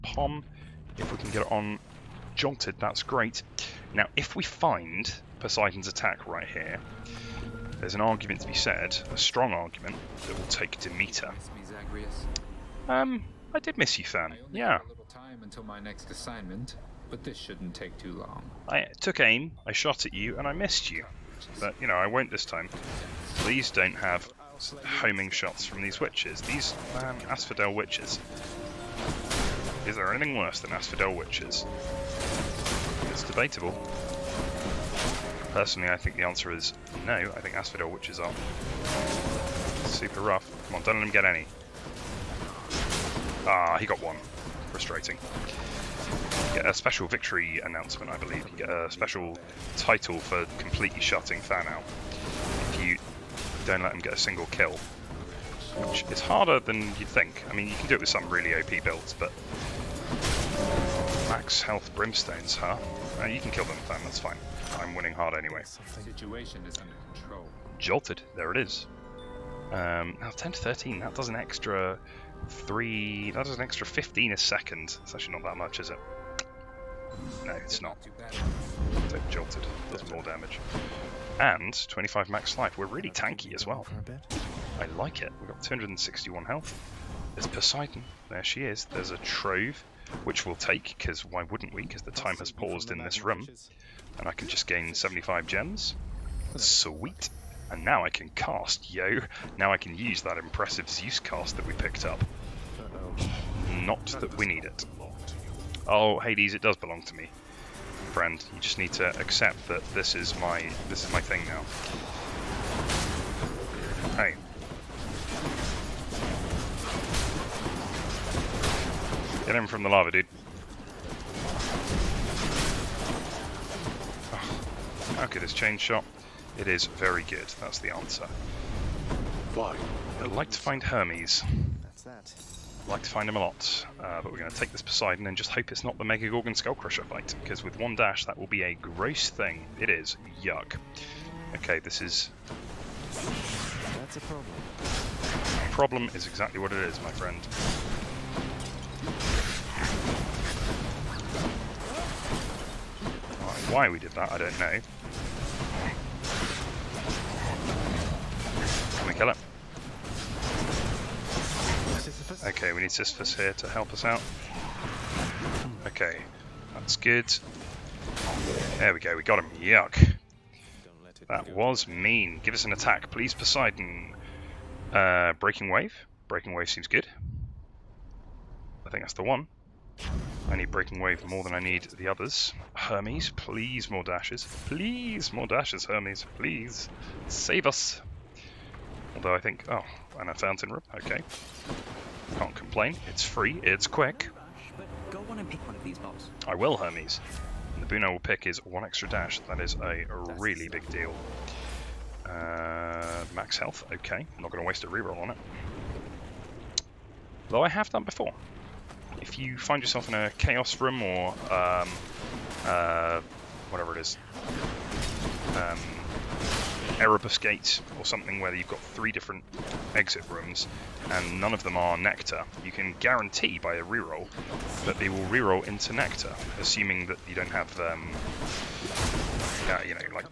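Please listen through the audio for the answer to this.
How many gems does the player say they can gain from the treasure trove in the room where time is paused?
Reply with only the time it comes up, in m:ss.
1:34.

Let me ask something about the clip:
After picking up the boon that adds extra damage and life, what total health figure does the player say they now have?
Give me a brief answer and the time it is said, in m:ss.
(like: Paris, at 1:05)
261, at 1:25.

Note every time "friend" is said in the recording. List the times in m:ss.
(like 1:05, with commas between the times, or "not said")
1:48, 2:27.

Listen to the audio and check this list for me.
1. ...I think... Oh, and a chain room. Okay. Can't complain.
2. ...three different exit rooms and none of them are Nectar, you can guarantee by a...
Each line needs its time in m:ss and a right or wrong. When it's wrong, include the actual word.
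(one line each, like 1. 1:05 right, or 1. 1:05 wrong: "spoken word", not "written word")
1. 3:09 wrong: "fountain", not "chain"
2. 3:38 right.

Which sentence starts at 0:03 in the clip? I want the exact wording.
Now, if we find Poseidon's attack right here, there's an argument to be said, a strong argument, that will take Demeter.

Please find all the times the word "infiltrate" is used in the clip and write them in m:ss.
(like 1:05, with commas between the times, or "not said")
not said.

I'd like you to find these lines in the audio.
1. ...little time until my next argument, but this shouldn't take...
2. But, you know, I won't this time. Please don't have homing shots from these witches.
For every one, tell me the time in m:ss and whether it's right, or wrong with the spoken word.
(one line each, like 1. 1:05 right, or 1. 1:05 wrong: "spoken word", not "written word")
1. 0:14 wrong: "assignment", not "argument"
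2. 0:21 right.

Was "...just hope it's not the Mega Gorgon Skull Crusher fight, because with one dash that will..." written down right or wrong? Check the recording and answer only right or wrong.
right.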